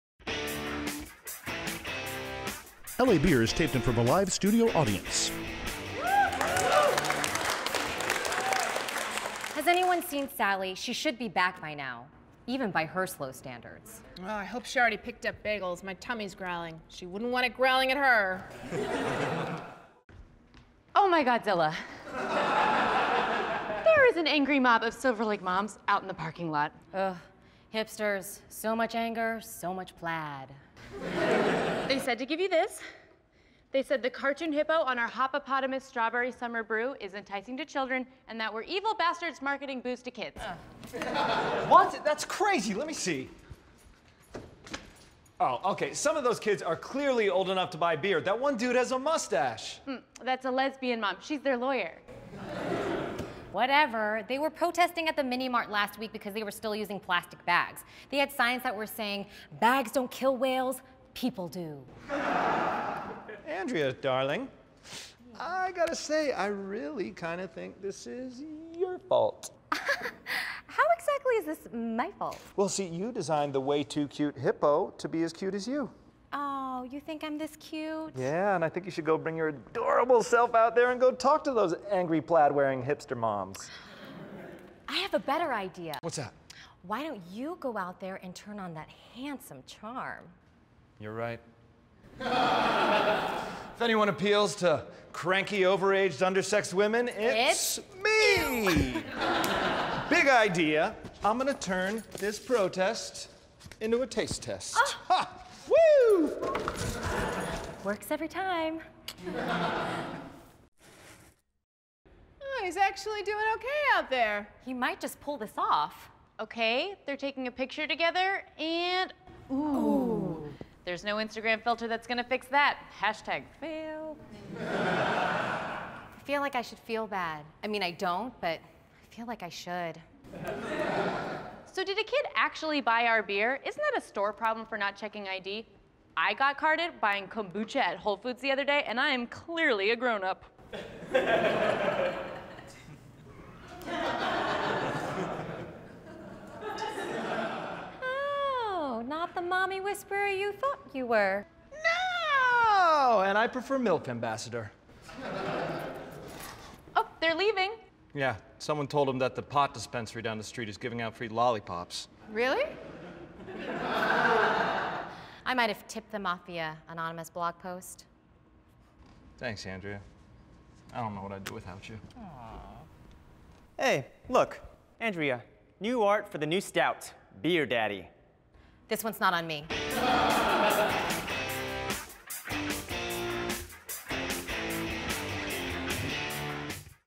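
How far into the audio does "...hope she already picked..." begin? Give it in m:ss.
0:14.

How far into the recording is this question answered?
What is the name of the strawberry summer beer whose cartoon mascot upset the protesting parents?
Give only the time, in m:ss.
0:35.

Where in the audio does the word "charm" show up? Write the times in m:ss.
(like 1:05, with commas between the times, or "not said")
1:29.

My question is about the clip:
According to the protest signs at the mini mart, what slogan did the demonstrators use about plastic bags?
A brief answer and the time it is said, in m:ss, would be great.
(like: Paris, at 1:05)
Bags don't kill whales, people do, at 0:59.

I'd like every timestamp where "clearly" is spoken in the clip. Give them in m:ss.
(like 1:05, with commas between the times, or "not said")
0:46, 2:19.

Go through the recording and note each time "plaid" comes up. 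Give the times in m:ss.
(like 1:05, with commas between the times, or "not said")
0:29, 1:22.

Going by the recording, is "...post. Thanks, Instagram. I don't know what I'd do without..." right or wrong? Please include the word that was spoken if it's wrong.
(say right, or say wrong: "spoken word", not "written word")
wrong: "Andrea", not "Instagram".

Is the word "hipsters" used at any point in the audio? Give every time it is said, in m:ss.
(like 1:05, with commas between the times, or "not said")
0:27, 1:22.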